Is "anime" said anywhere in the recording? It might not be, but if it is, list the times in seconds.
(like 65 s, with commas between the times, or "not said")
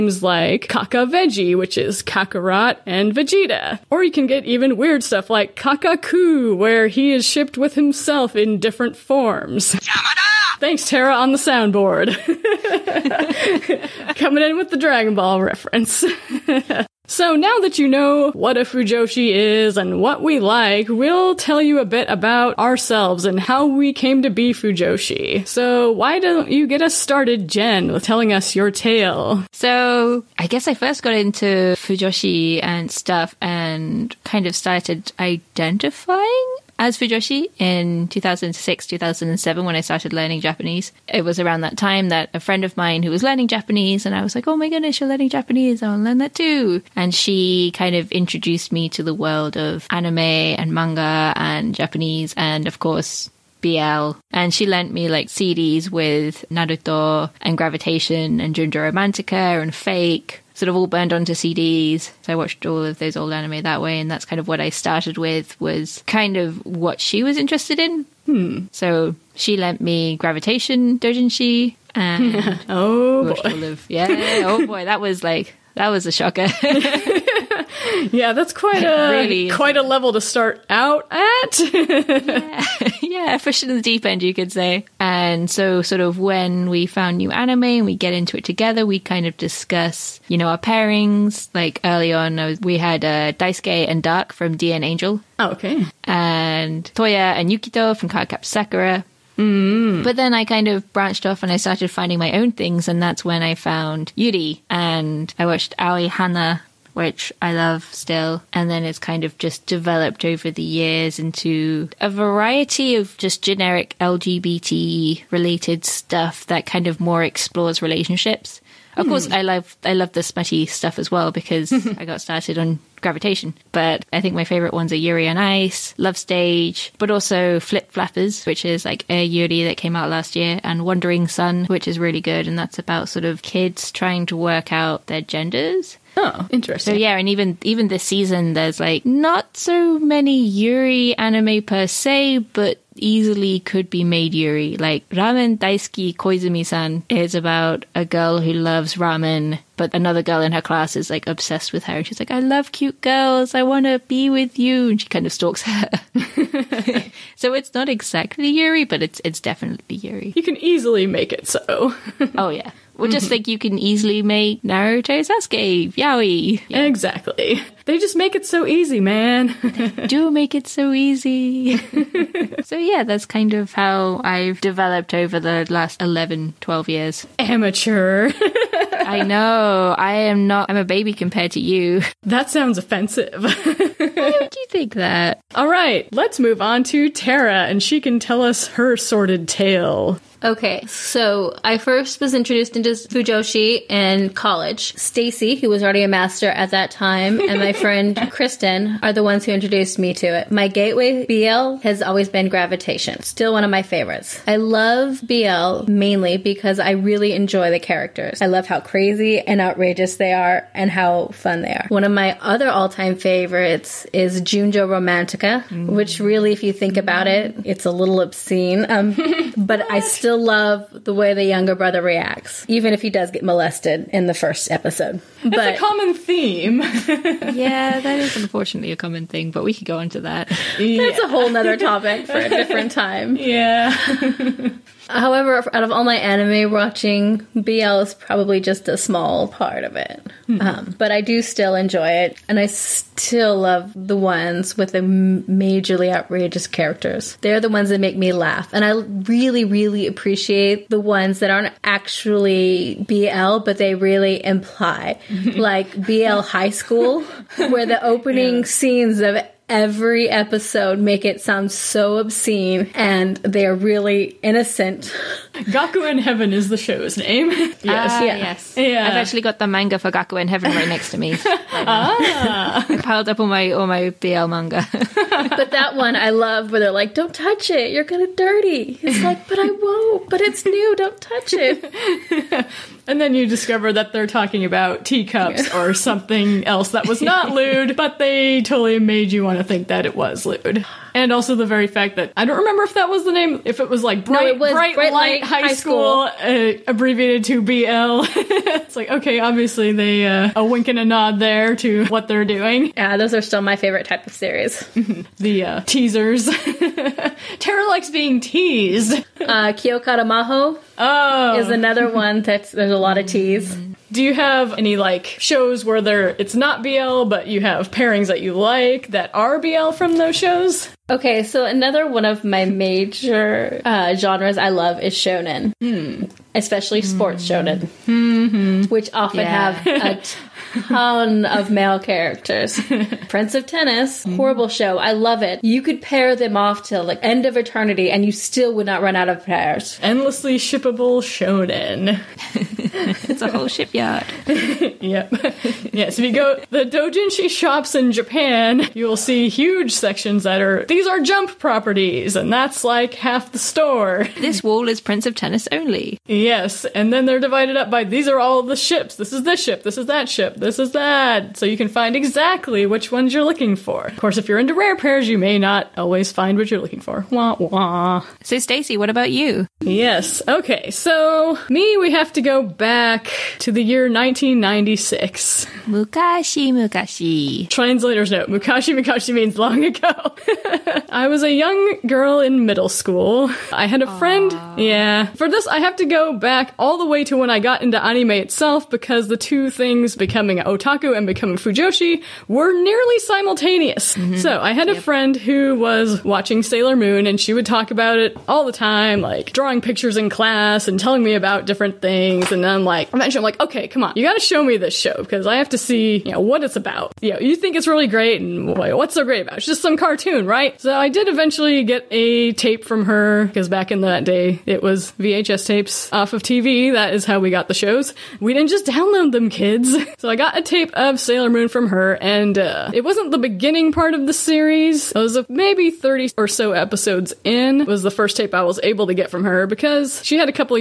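49 s, 63 s, 87 s, 141 s, 236 s, 388 s.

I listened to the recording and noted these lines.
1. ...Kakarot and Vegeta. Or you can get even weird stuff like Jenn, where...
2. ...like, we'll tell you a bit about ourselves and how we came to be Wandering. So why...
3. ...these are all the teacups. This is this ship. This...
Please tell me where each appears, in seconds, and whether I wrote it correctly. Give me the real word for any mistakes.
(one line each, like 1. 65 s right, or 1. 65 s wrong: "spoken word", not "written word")
1. 2 s wrong: "Kakaku", not "Jenn"
2. 20 s wrong: "Fujoshi", not "Wandering"
3. 358 s wrong: "ships", not "teacups".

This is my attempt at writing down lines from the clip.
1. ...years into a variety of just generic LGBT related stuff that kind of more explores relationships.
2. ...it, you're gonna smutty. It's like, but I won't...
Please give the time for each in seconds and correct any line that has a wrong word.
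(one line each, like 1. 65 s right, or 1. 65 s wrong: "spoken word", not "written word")
1. 110 s right
2. 277 s wrong: "dirty", not "smutty".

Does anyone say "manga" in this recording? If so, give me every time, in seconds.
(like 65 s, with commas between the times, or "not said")
50 s, 269 s, 274 s.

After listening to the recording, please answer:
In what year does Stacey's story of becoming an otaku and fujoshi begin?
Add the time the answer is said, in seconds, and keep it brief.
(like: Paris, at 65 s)
1996, at 374 s.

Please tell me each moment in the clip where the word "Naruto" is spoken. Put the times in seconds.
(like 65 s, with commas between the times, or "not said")
56 s, 164 s.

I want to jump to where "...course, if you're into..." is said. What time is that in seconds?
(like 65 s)
364 s.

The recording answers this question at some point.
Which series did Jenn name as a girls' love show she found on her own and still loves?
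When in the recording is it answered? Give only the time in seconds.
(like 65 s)
105 s.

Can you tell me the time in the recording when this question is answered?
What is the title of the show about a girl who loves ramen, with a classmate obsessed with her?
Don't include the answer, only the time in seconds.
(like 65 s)
145 s.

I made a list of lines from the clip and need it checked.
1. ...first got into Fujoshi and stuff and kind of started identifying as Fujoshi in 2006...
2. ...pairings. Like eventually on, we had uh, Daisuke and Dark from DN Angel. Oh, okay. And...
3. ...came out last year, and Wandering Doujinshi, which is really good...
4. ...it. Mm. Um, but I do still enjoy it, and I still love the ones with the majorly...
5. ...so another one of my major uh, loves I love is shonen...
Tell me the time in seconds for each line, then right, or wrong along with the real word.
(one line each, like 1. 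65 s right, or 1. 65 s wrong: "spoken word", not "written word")
1. 30 s right
2. 90 s wrong: "early", not "eventually"
3. 129 s wrong: "Son", not "Doujinshi"
4. 239 s right
5. 321 s wrong: "genres", not "loves".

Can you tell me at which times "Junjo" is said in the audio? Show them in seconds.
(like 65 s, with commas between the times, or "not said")
58 s, 214 s.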